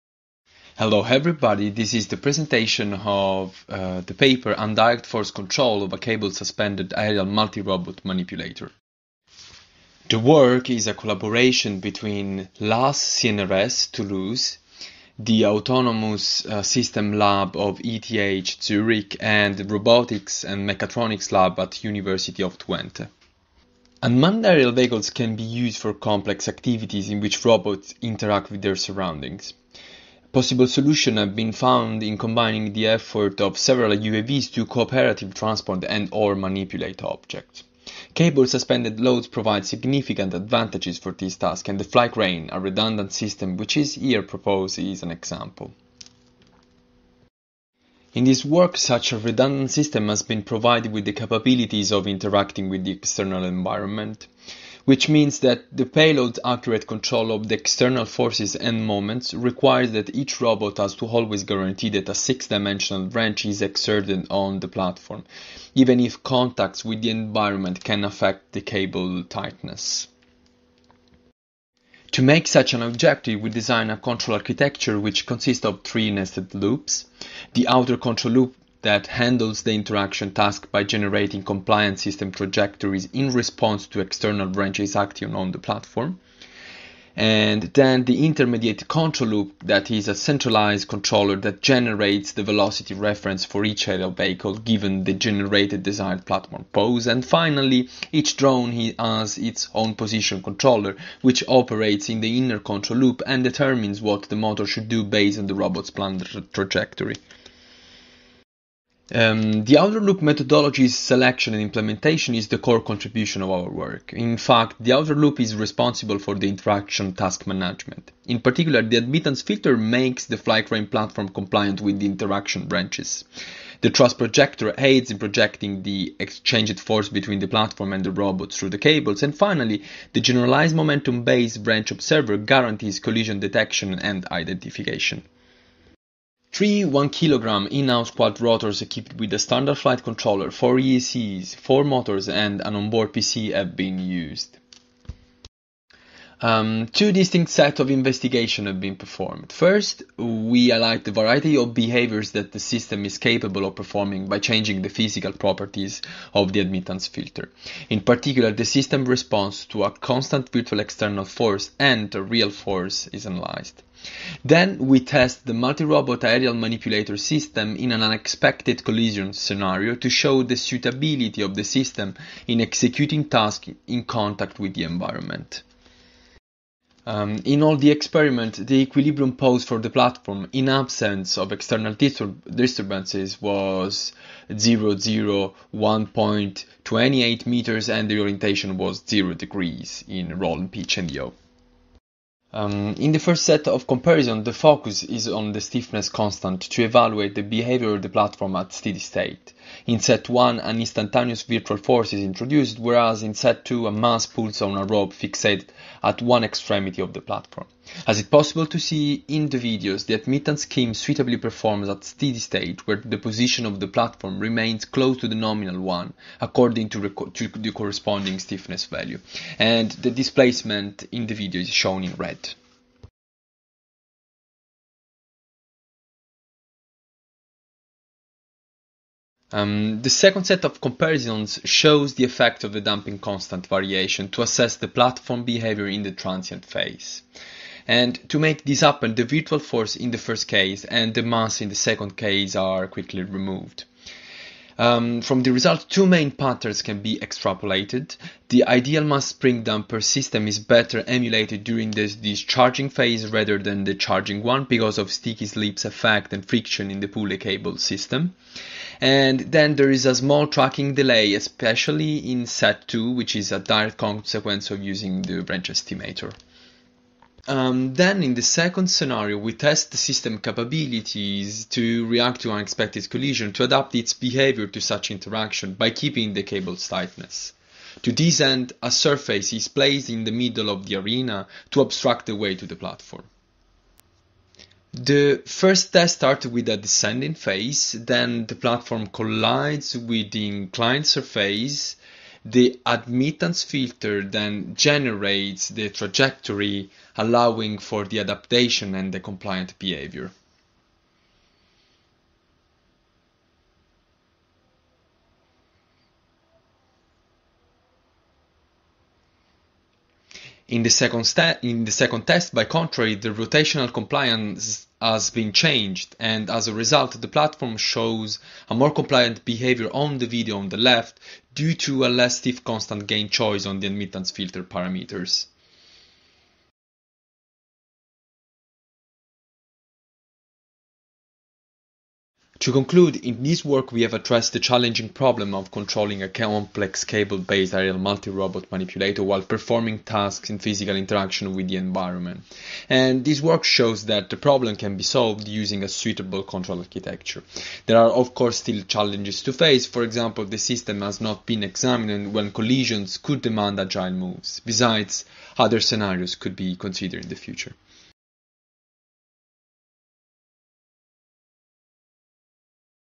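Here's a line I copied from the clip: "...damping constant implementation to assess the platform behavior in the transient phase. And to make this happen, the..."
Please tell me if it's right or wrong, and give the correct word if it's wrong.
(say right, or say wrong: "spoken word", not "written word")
wrong: "variation", not "implementation".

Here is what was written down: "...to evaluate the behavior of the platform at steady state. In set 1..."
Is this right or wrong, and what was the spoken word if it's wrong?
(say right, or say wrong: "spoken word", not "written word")
right.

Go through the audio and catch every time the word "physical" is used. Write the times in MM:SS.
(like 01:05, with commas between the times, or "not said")
02:34, 05:40.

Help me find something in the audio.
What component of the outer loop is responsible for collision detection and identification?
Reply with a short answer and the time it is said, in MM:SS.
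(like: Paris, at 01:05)
generalized momentum-based wrench observer, at 02:10.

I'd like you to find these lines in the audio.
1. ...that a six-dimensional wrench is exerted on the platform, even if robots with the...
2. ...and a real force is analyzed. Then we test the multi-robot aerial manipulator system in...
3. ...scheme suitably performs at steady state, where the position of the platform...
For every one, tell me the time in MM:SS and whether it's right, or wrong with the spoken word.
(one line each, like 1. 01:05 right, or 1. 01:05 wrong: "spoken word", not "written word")
1. 01:01 wrong: "contacts", not "robots"
2. 02:41 right
3. 03:30 right.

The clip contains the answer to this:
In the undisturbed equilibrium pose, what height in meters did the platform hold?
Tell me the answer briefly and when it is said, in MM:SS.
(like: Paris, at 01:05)
1.28 meters, at 03:05.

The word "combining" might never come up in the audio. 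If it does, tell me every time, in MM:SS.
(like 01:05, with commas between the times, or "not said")
00:32.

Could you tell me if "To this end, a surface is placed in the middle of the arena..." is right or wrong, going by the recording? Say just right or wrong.
right.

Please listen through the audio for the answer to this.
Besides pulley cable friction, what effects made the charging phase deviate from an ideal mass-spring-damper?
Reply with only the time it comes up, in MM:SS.
04:15.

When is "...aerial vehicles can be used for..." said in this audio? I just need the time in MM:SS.
00:24.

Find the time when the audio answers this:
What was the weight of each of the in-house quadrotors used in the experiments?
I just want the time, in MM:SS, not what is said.
02:16.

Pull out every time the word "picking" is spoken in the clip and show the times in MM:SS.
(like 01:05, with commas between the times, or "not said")
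not said.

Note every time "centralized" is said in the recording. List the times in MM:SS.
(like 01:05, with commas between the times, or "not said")
01:30.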